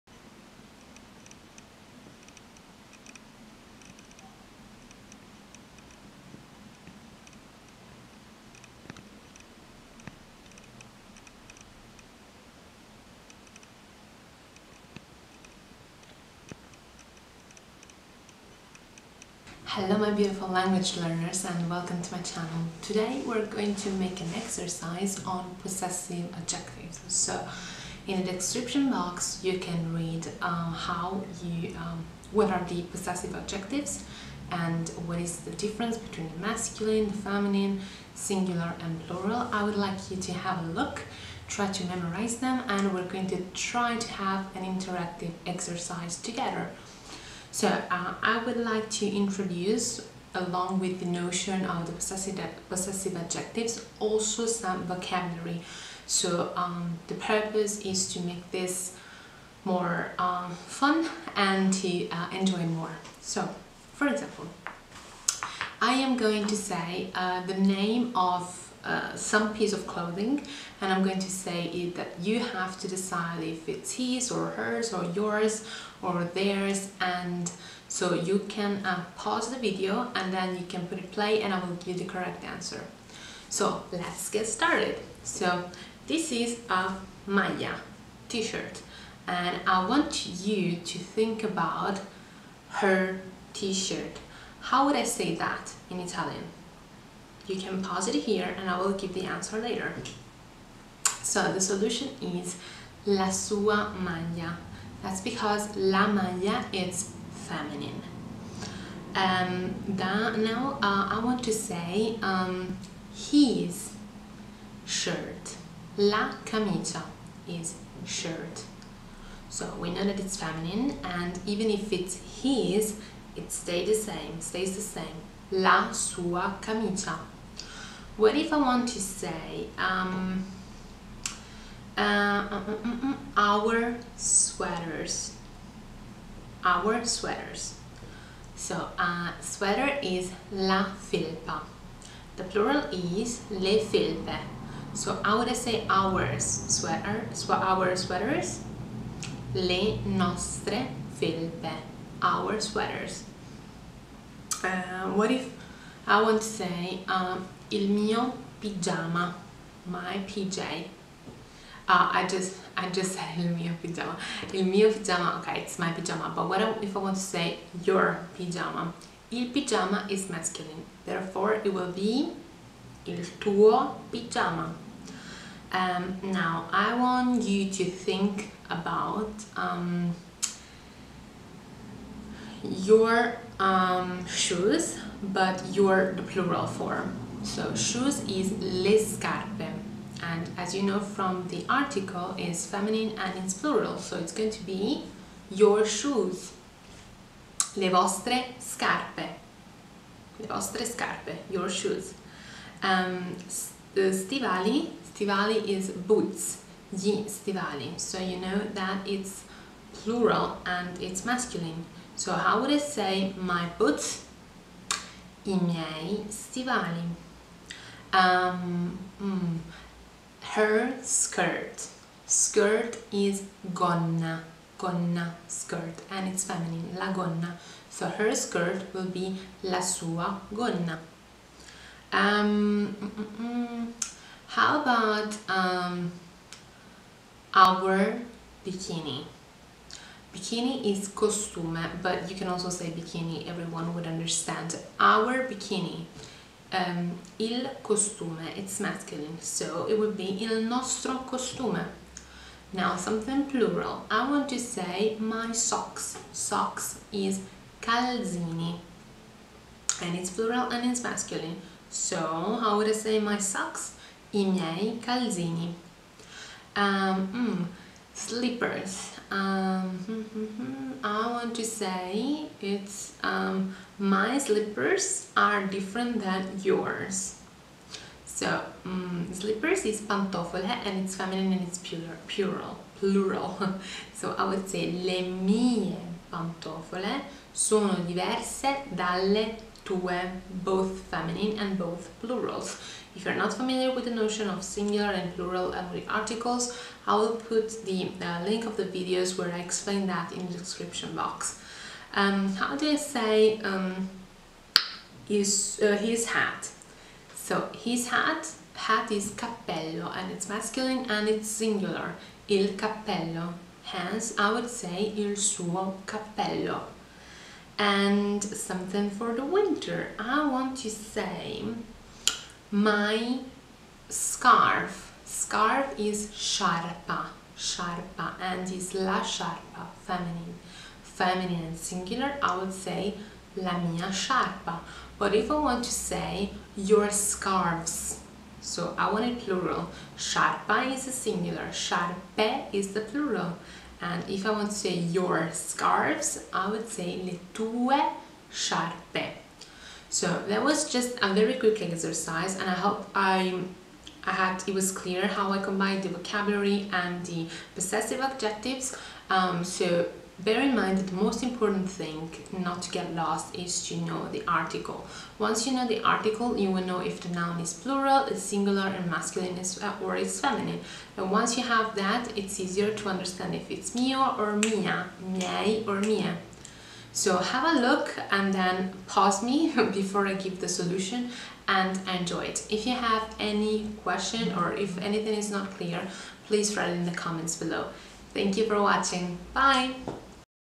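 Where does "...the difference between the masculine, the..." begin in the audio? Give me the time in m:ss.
0:35.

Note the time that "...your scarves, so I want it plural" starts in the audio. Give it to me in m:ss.
5:36.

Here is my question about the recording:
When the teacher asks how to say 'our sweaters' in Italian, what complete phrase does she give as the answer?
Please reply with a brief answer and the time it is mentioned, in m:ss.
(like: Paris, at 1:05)
le nostre felpe, at 2:29.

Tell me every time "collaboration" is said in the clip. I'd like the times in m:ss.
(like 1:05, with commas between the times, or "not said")
not said.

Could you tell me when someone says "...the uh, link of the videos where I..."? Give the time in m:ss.
4:57.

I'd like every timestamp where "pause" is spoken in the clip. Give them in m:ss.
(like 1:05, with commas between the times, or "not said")
1:19, 1:37, 6:19.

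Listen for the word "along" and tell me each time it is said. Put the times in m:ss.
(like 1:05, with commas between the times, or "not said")
0:50.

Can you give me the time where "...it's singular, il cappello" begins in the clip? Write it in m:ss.
5:11.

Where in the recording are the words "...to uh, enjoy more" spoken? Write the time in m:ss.
1:01.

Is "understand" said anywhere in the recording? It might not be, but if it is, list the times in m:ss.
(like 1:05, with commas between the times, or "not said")
4:04, 6:13.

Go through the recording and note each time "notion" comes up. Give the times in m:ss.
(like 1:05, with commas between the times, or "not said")
0:51, 4:54.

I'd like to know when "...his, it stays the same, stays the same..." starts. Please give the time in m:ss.
2:02.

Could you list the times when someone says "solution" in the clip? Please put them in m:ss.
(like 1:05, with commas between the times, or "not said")
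1:41, 6:20.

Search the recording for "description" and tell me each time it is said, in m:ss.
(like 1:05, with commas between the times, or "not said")
0:28, 5:00.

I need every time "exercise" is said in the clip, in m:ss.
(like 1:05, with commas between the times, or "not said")
0:24, 0:45, 5:51.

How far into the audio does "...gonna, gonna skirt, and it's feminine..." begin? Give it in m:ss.
3:43.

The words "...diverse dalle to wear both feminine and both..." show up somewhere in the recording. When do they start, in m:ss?
4:48.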